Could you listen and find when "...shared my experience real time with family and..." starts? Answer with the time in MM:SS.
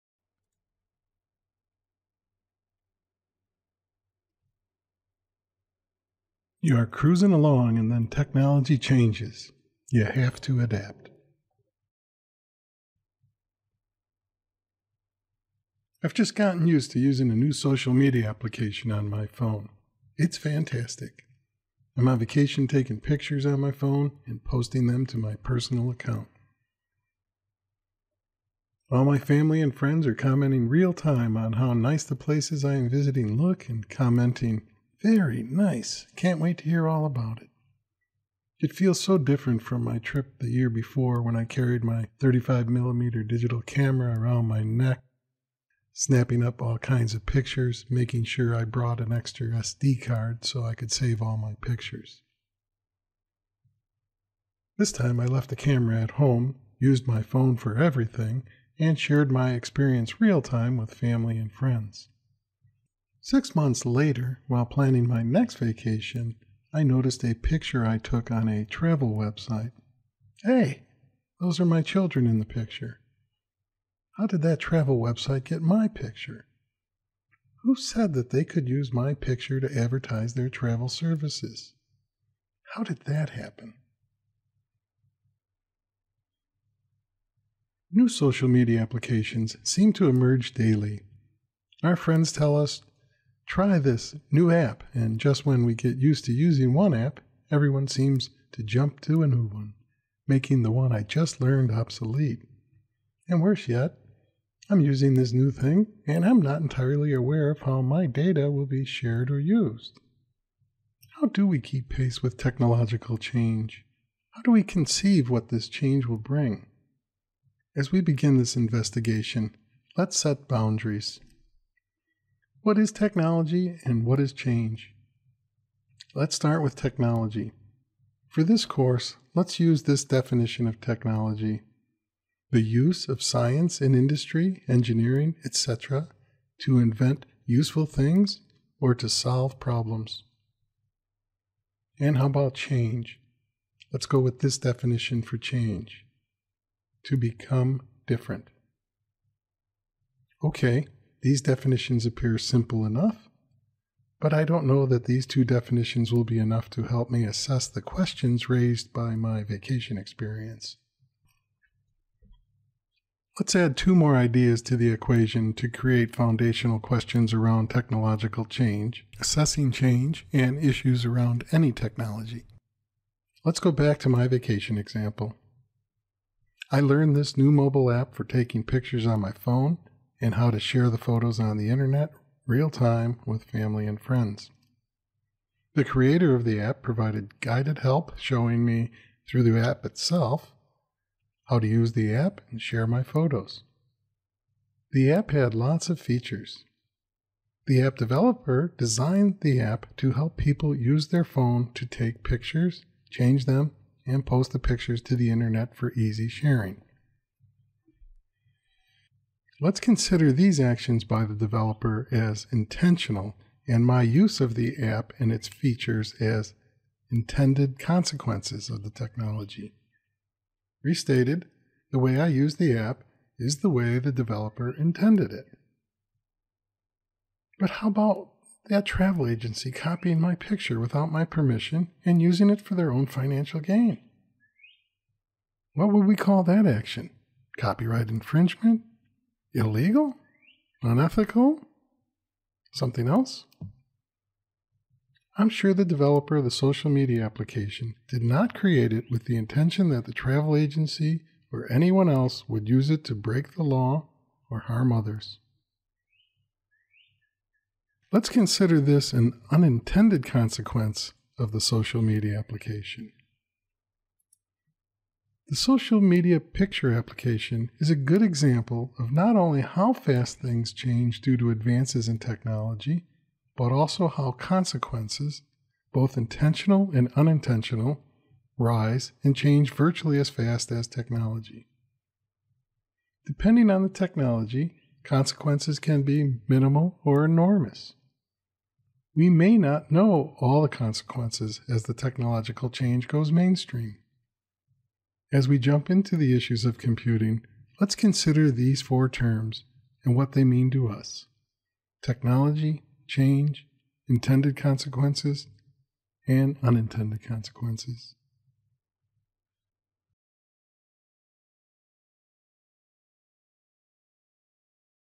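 00:58.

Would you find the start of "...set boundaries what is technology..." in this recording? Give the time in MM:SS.
02:00.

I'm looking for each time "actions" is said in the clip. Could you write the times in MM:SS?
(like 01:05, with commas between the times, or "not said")
03:30, 03:56.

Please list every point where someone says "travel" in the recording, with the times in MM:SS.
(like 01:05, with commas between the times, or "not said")
01:08, 01:14, 01:20, 03:48, 04:10.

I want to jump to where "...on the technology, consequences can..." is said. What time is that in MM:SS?
04:43.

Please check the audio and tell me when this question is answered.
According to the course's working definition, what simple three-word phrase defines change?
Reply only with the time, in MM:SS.
02:27.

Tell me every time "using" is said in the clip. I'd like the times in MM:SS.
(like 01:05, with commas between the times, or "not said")
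00:16, 01:36, 01:44, 03:52.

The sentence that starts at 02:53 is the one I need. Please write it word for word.
Let's go back to my vacation example.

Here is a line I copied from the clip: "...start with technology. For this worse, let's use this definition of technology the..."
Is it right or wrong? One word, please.
wrong.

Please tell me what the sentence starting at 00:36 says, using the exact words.
Can't wait to hear all about it.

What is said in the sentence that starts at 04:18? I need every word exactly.
Let's consider this an unintended consequence of the social media application.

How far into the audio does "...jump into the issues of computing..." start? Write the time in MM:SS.
04:55.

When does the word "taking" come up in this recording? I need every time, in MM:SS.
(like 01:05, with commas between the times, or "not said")
00:22, 02:58.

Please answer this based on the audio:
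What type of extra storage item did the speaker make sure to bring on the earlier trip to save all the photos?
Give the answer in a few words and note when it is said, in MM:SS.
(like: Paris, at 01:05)
SD card, at 00:49.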